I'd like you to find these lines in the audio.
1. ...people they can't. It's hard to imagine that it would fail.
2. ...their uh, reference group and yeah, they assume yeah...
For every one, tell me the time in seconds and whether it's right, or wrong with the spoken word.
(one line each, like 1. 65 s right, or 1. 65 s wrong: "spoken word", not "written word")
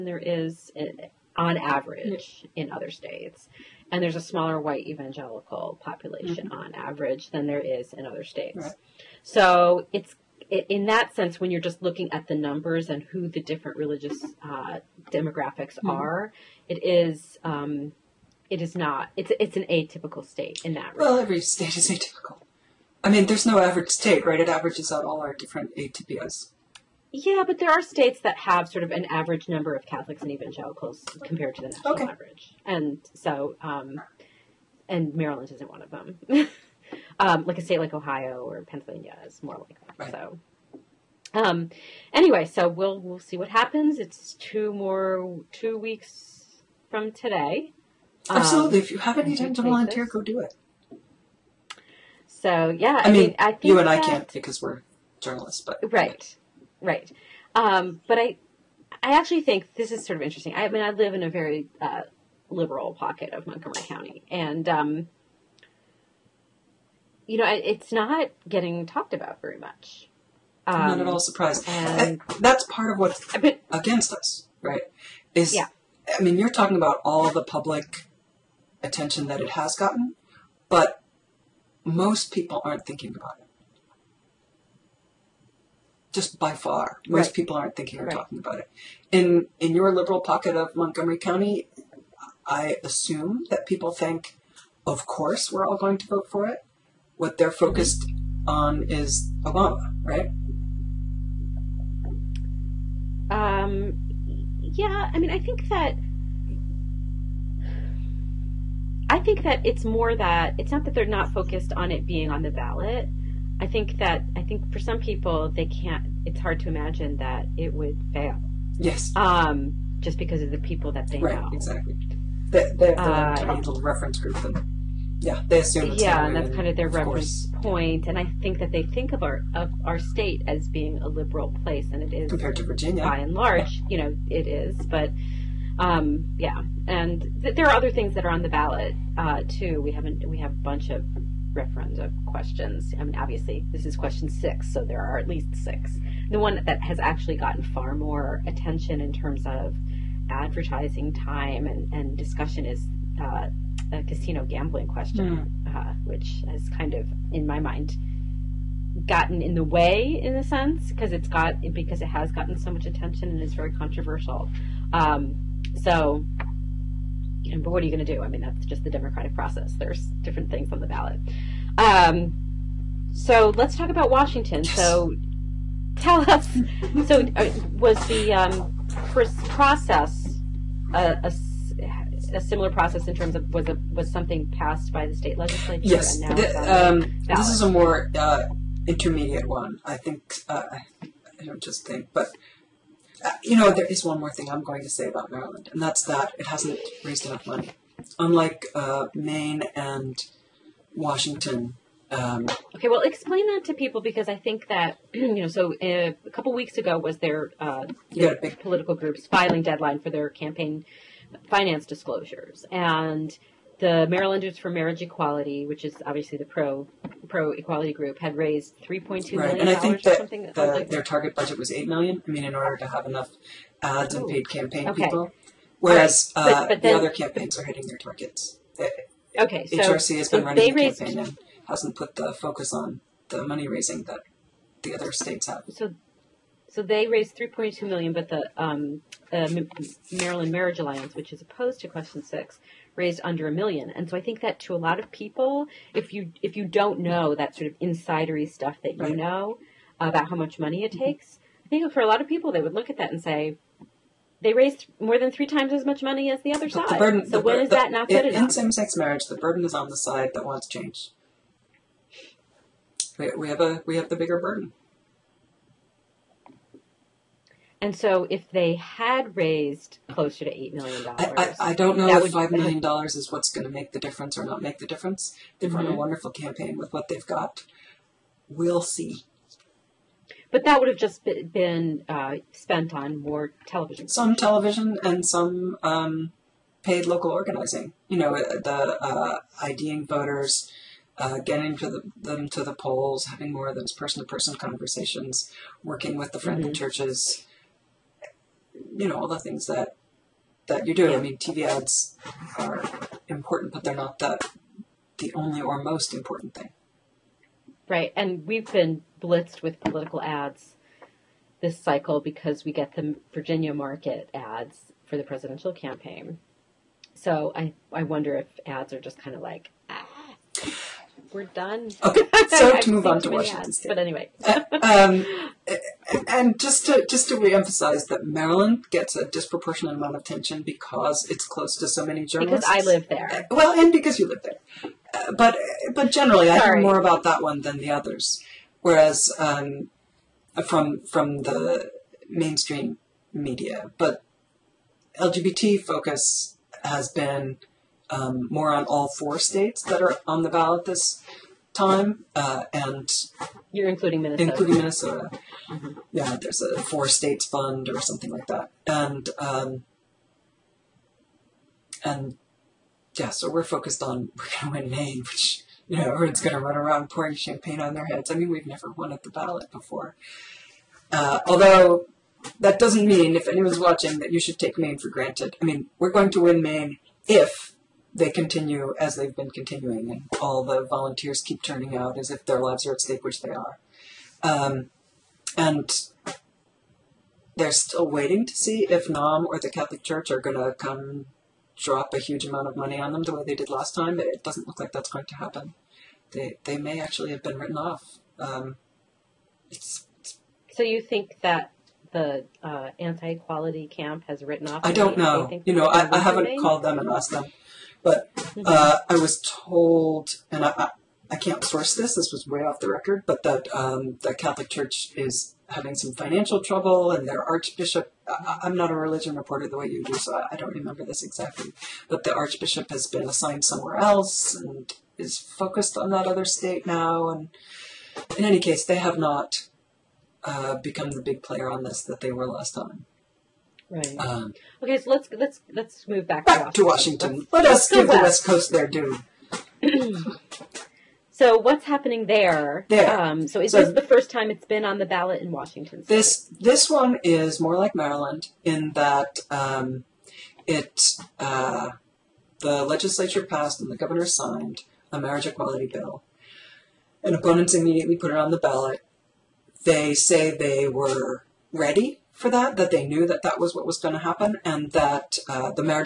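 1. 114 s right
2. 123 s right.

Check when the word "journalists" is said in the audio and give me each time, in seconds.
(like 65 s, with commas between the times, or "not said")
55 s, 332 s.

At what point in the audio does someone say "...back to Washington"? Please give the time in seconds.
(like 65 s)
436 s.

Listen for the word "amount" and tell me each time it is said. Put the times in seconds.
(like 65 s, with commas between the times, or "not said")
329 s, 392 s.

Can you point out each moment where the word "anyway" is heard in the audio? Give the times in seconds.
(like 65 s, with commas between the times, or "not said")
42 s, 323 s.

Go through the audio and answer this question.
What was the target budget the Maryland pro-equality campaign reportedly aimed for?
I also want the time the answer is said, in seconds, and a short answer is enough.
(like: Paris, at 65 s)
8 million, at 221 s.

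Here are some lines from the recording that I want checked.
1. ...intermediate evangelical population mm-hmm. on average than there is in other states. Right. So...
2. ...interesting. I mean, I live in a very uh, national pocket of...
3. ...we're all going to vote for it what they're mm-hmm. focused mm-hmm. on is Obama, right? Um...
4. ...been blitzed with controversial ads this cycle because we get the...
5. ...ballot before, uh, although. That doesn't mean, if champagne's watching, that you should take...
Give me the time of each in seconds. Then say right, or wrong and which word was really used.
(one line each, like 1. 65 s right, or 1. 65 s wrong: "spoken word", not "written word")
1. 4 s wrong: "white", not "intermediate"
2. 60 s wrong: "liberal", not "national"
3. 95 s right
4. 308 s wrong: "political", not "controversial"
5. 369 s wrong: "anyone", not "champagne".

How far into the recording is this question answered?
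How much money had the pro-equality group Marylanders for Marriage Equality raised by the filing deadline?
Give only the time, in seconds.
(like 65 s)
218 s.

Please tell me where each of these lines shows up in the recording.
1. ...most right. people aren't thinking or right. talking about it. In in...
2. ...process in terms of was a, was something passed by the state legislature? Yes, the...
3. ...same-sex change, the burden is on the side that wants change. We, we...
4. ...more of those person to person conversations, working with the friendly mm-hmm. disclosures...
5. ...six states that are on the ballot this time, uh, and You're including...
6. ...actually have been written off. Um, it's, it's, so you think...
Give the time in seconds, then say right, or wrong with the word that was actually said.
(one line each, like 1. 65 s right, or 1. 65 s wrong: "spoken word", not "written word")
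1. 87 s right
2. 182 s right
3. 258 s wrong: "marriage", not "change"
4. 293 s wrong: "churches", not "disclosures"
5. 349 s wrong: "four", not "six"
6. 397 s right.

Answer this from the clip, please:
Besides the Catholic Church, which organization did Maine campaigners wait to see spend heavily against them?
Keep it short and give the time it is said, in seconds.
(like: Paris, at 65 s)
NOM, at 389 s.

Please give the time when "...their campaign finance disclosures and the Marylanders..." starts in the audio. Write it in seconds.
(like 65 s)
210 s.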